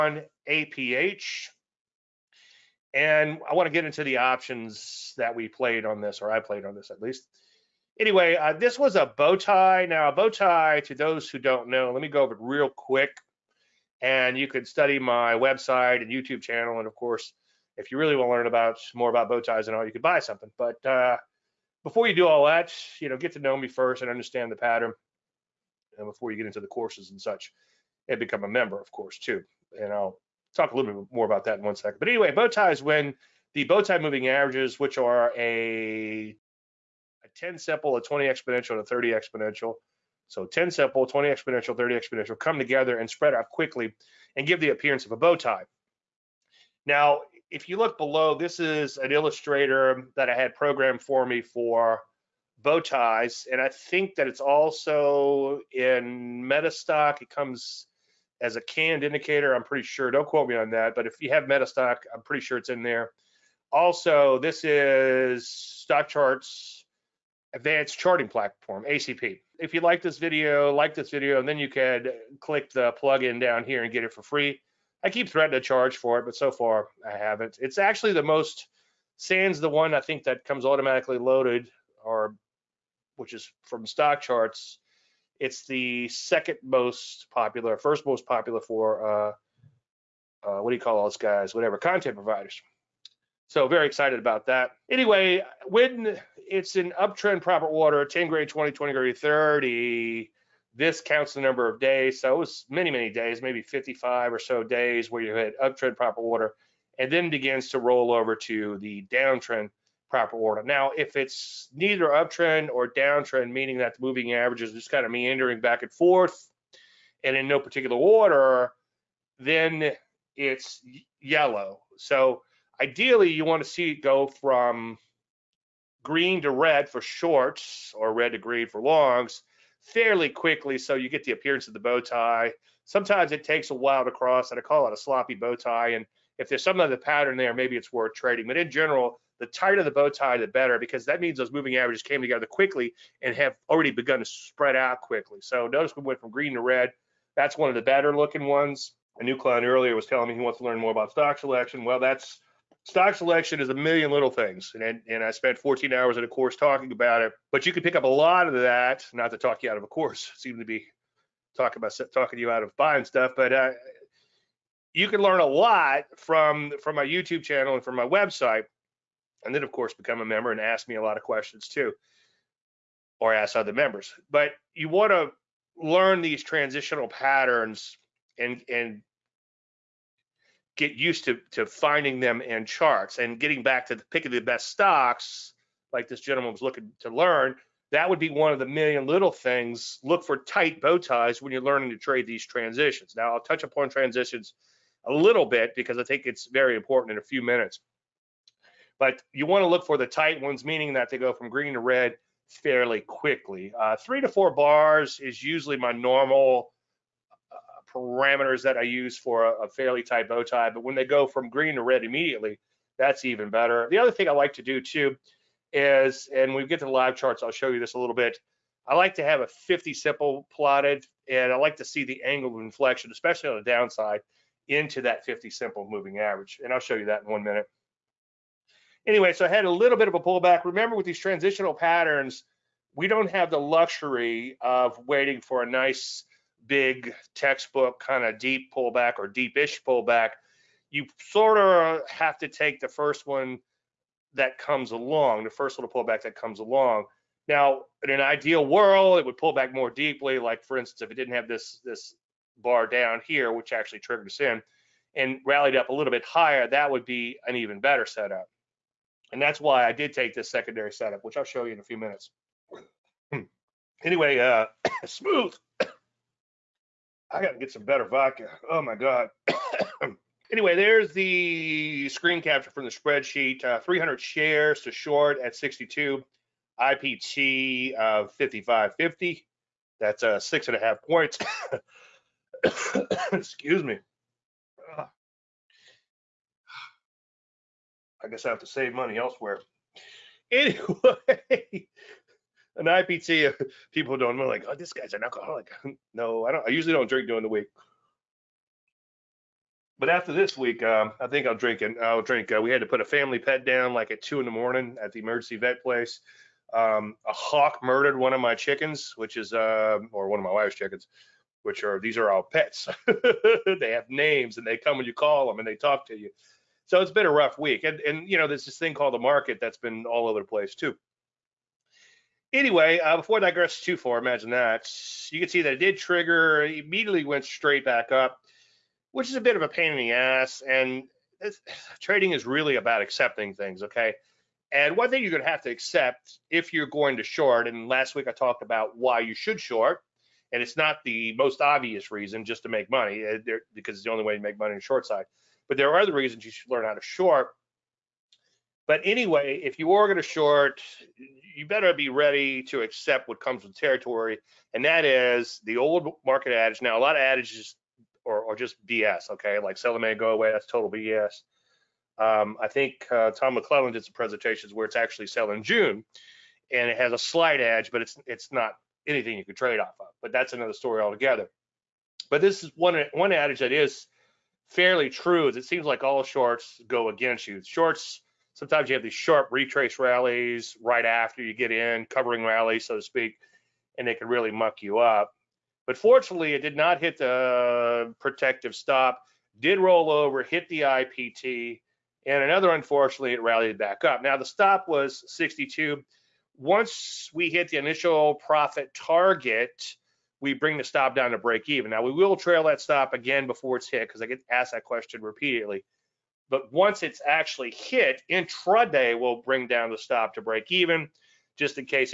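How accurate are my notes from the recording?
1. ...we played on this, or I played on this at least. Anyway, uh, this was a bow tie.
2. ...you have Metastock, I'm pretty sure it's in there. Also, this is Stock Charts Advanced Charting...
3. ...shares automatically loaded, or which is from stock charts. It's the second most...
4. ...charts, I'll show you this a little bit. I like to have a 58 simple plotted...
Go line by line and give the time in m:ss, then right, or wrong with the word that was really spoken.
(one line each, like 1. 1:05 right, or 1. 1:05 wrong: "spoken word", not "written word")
1. 0:05 right
2. 1:01 right
3. 1:20 wrong: "comes", not "shares"
4. 3:37 wrong: "50", not "58".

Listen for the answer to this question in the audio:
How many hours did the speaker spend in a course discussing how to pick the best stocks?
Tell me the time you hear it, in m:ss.
2:35.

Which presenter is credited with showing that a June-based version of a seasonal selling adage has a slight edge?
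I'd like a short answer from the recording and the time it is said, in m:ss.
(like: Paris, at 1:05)
Tom McClellan, at 6:03.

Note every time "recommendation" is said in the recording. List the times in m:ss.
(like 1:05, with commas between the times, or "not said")
not said.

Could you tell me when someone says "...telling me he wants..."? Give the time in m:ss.
2:30.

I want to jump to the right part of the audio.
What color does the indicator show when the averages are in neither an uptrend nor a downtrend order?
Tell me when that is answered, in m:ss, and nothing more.
2:01.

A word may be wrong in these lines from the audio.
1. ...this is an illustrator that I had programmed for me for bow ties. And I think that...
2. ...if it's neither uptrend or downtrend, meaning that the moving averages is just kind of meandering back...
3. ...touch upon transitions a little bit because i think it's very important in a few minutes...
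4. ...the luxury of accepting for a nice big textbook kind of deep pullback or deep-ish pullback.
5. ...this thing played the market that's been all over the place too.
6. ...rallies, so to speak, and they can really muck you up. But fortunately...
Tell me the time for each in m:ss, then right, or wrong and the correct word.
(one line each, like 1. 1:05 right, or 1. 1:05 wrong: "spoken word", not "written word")
1. 0:48 right
2. 1:50 right
3. 3:13 right
4. 3:53 wrong: "waiting", not "accepting"
5. 5:18 wrong: "called", not "played"
6. 6:22 right.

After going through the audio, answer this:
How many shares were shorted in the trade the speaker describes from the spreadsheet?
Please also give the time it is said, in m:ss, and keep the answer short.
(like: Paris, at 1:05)
300, at 4:33.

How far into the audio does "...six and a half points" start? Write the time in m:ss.
4:40.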